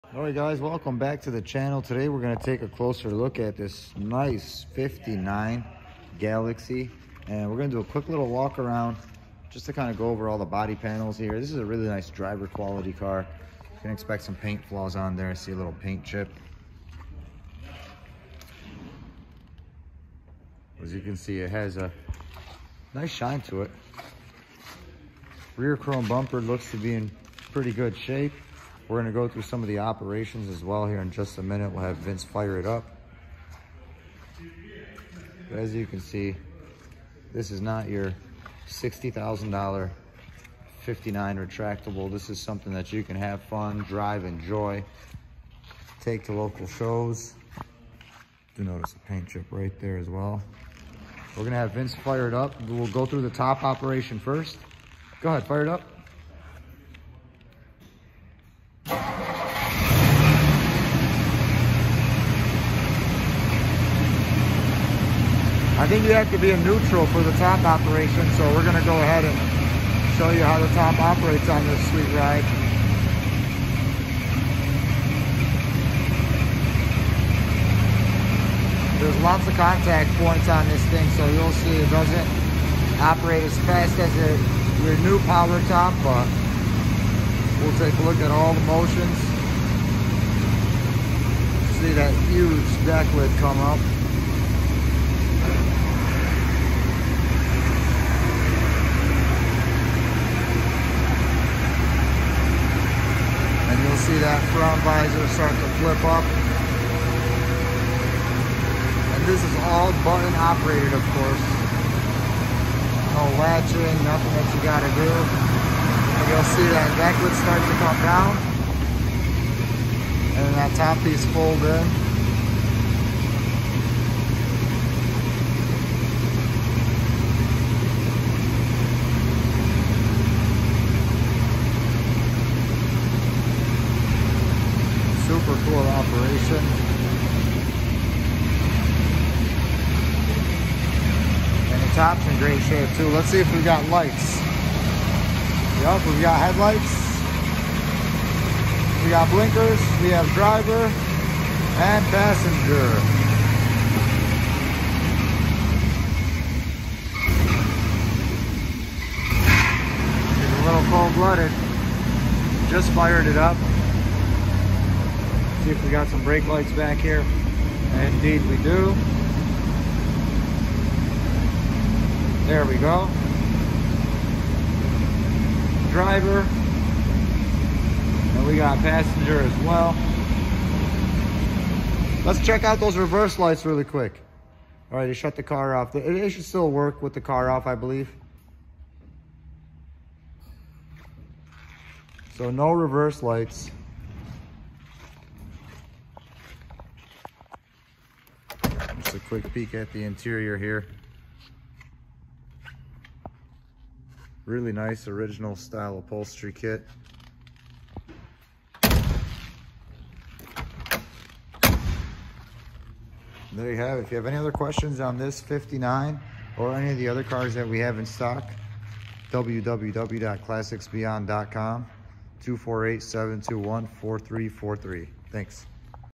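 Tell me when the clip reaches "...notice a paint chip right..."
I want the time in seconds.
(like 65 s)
48 s.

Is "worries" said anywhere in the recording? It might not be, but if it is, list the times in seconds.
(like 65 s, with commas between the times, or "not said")
not said.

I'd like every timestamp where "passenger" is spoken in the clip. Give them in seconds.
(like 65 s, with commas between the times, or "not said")
152 s, 178 s.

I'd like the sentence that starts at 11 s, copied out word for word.
This is a really nice driver quality car.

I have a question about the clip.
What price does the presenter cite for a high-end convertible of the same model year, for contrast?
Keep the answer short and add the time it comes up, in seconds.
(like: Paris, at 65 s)
$60,000, at 38 s.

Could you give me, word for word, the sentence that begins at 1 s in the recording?
Today, we're going to take a closer look at this nice 59 Galaxie.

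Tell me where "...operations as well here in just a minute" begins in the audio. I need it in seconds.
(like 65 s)
29 s.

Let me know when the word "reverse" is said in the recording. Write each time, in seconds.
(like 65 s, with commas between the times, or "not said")
182 s, 192 s.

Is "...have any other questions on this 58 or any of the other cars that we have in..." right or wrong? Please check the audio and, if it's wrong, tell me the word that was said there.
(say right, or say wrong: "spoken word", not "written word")
wrong: "59", not "58".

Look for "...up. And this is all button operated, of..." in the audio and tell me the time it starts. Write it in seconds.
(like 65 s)
106 s.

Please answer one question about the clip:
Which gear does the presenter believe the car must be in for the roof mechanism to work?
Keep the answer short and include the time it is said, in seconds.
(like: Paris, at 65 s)
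Neutral, at 66 s.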